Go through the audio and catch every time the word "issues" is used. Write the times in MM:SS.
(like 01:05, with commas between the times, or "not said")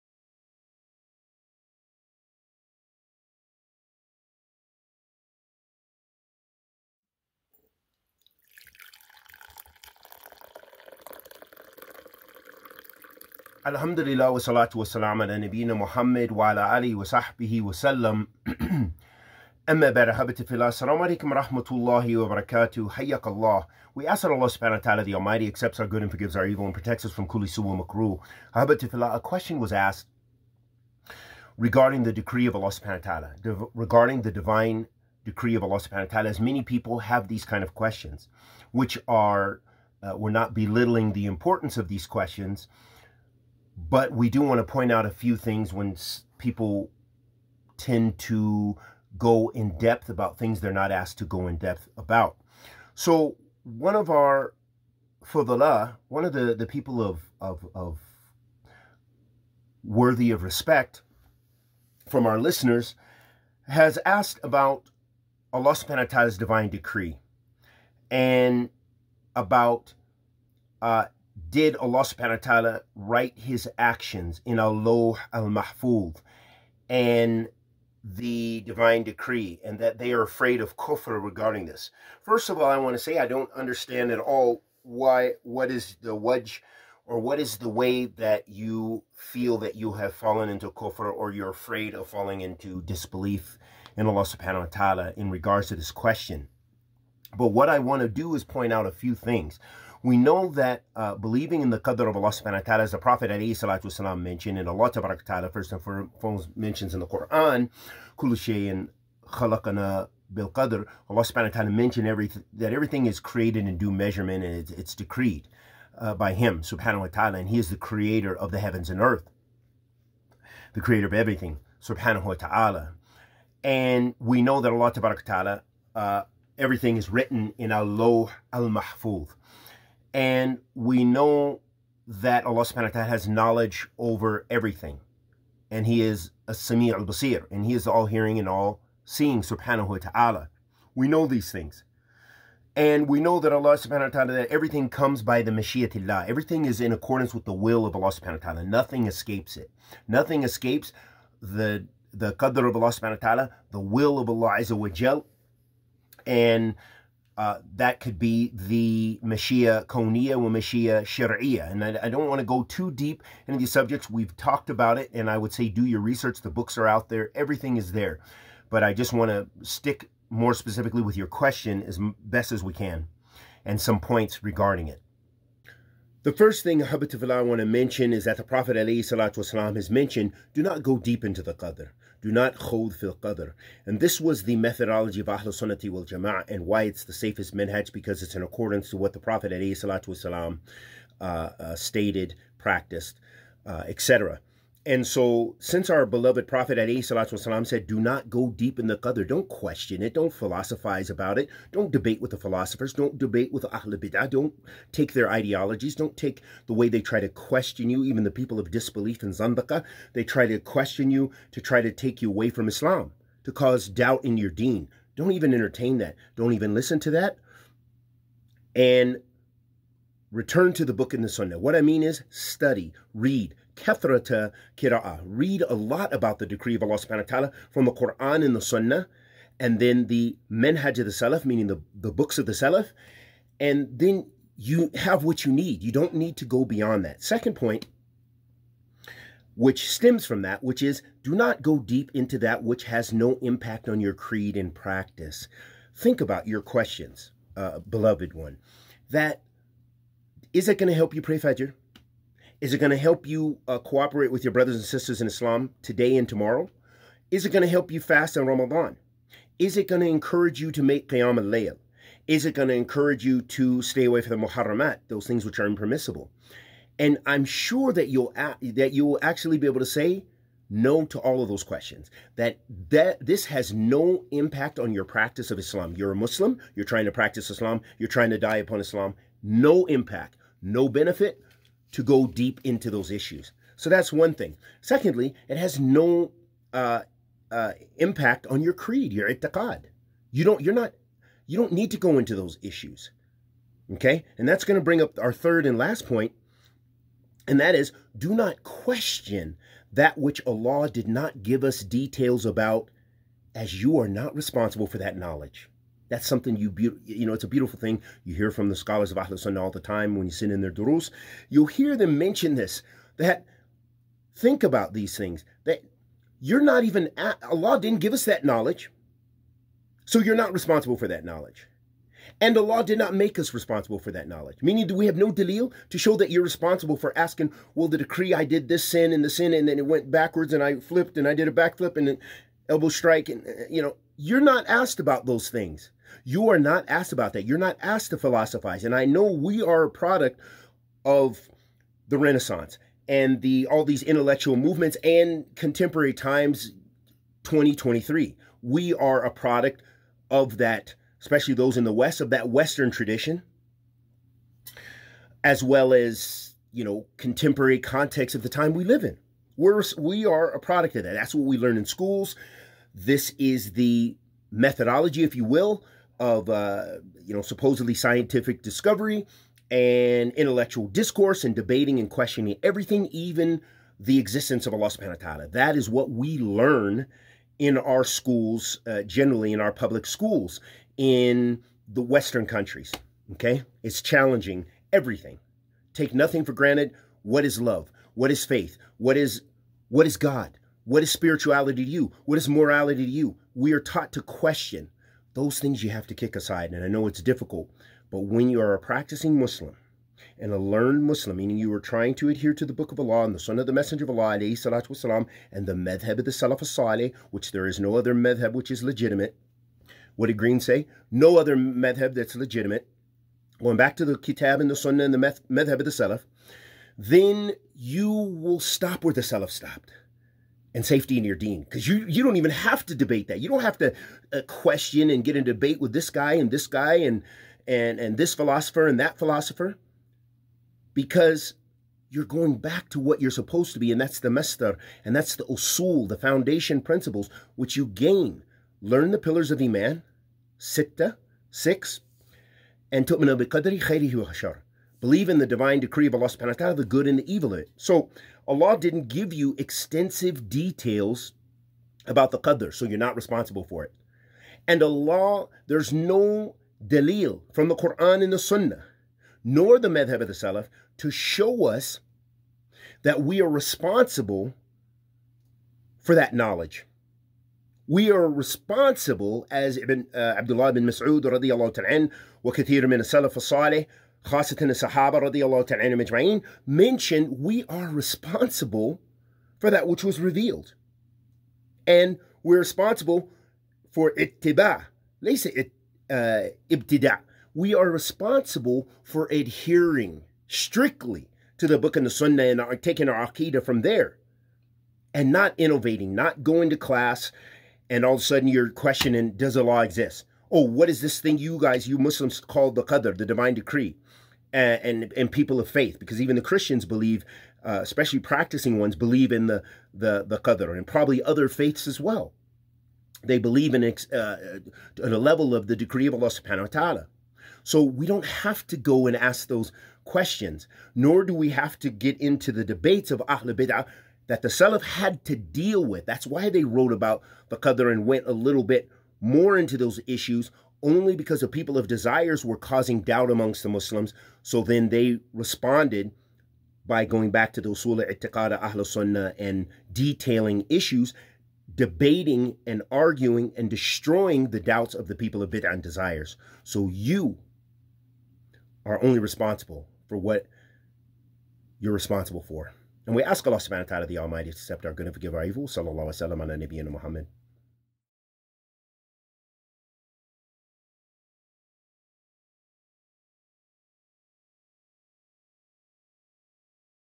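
04:43, 04:52, 08:50, 09:00.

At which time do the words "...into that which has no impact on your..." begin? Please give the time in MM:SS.
04:02.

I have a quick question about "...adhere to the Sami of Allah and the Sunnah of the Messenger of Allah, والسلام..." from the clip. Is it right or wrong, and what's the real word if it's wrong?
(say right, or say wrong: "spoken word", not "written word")
wrong: "Book", not "Sami".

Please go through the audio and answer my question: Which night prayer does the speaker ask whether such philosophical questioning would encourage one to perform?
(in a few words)
Qiyam al-Layl.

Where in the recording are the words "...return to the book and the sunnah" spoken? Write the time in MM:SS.
03:40.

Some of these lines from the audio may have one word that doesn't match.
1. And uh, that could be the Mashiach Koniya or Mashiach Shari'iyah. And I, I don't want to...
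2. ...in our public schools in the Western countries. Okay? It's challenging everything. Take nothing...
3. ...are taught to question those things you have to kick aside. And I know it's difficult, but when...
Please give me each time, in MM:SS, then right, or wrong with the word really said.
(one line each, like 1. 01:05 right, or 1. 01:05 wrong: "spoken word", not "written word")
1. 02:36 right
2. 06:19 right
3. 06:33 right.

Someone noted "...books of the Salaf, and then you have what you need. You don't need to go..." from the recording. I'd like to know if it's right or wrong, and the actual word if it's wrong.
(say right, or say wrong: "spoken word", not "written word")
right.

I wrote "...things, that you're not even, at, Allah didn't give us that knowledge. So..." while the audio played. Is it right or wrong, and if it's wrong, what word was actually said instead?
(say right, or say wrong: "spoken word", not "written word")
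right.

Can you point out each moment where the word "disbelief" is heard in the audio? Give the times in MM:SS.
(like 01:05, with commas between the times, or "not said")
01:32, 03:28.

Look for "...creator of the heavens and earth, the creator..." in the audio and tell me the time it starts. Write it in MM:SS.
01:57.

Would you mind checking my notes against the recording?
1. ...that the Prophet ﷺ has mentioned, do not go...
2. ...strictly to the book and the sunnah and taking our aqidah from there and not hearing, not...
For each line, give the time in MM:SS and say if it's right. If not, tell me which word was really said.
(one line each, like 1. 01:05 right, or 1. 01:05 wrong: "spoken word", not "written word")
1. 02:58 right
2. 08:10 wrong: "innovating", not "hearing".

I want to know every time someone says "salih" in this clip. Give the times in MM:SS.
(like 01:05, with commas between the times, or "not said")
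06:46, 07:53.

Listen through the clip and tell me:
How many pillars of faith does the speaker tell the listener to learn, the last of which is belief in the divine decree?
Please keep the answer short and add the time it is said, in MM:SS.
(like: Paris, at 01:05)
6, at 07:21.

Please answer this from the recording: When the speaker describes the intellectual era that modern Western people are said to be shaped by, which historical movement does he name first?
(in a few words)
Renaissance.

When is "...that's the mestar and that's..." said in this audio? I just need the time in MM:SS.
07:13.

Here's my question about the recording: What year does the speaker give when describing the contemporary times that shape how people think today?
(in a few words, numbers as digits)
2023.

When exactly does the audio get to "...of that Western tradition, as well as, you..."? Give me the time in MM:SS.
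05:52.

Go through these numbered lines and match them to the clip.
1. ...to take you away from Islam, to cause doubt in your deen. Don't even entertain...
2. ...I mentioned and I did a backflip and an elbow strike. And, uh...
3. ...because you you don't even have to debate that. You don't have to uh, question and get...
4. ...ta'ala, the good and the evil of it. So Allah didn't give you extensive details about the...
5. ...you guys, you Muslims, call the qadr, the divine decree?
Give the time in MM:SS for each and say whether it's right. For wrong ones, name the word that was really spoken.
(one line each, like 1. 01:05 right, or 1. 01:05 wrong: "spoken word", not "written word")
1. 03:31 right
2. 05:30 wrong: "flipped", not "mentioned"
3. 07:01 right
4. 07:26 right
5. 08:21 right.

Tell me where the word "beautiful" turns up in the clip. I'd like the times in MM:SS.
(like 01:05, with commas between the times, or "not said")
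05:07.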